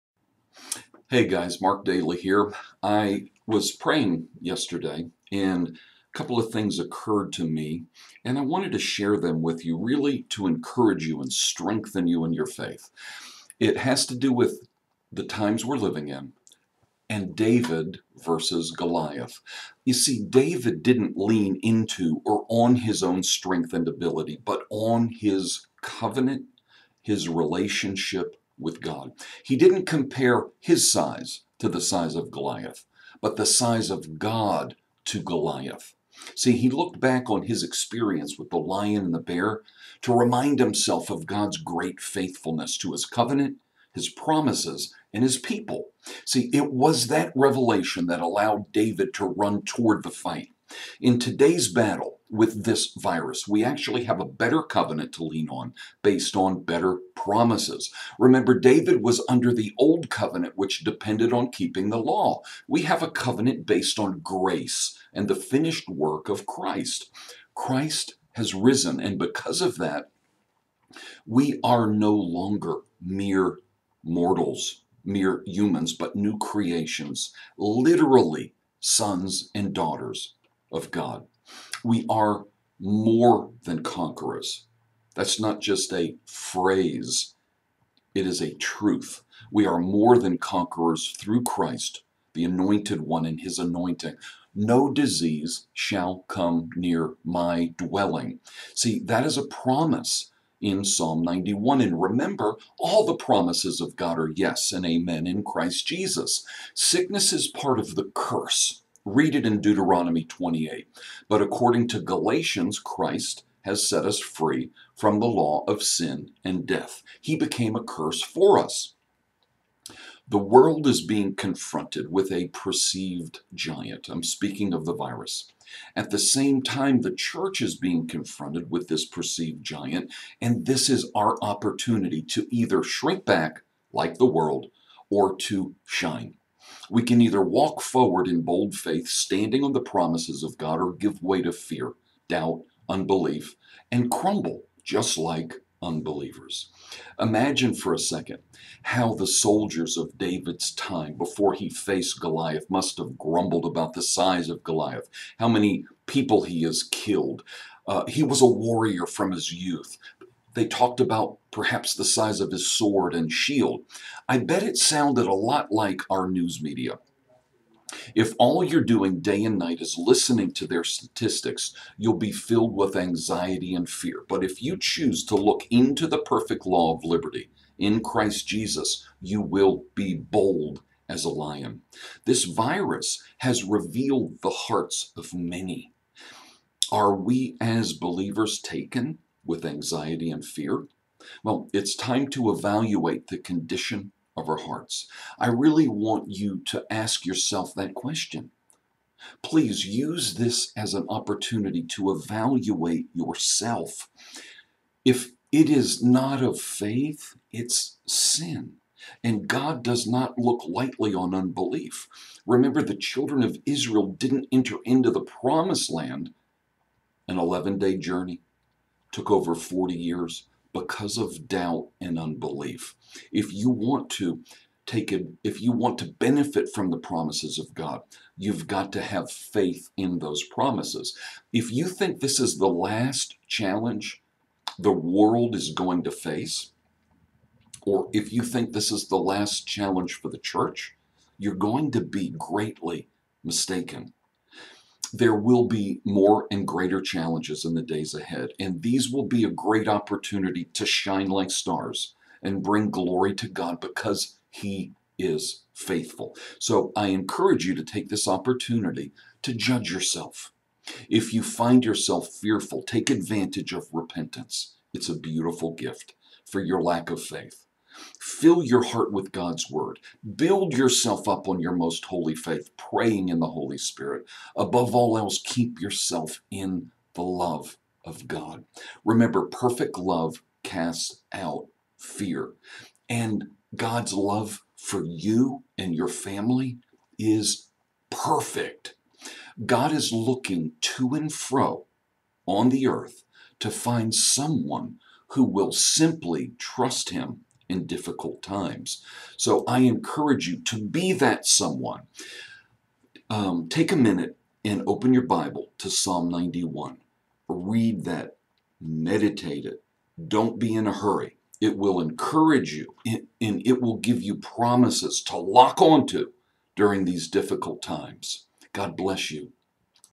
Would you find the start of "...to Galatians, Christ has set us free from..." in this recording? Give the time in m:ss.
1:51.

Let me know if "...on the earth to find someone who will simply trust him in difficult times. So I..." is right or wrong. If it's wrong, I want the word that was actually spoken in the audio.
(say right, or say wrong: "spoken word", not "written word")
right.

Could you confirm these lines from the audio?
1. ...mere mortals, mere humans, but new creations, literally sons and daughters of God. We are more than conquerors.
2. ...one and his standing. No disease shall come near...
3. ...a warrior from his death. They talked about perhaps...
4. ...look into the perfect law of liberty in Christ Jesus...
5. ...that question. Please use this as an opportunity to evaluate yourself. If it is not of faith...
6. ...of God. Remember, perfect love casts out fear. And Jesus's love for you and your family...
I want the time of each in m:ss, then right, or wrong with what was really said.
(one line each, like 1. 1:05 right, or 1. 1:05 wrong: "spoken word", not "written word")
1. 1:13 right
2. 1:33 wrong: "anointing", not "standing"
3. 2:38 wrong: "youth", not "death"
4. 2:55 right
5. 3:17 right
6. 4:38 wrong: "God", not "Jesus".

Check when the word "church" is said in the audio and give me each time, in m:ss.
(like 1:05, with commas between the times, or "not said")
2:07, 4:00.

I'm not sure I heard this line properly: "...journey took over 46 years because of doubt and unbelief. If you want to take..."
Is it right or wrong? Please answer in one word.
wrong.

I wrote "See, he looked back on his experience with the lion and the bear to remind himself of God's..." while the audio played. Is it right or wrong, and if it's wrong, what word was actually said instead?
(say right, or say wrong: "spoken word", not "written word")
right.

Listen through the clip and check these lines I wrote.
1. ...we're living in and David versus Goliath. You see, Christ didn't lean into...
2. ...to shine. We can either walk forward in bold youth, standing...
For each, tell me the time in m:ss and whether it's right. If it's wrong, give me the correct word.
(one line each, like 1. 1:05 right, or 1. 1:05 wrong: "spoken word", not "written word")
1. 0:15 wrong: "David", not "Christ"
2. 2:15 wrong: "faith", not "youth".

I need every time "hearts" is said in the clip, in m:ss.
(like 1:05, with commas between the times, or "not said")
3:04, 3:14, 4:28.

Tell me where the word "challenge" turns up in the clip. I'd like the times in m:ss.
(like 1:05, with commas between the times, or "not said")
3:53, 3:59, 4:07.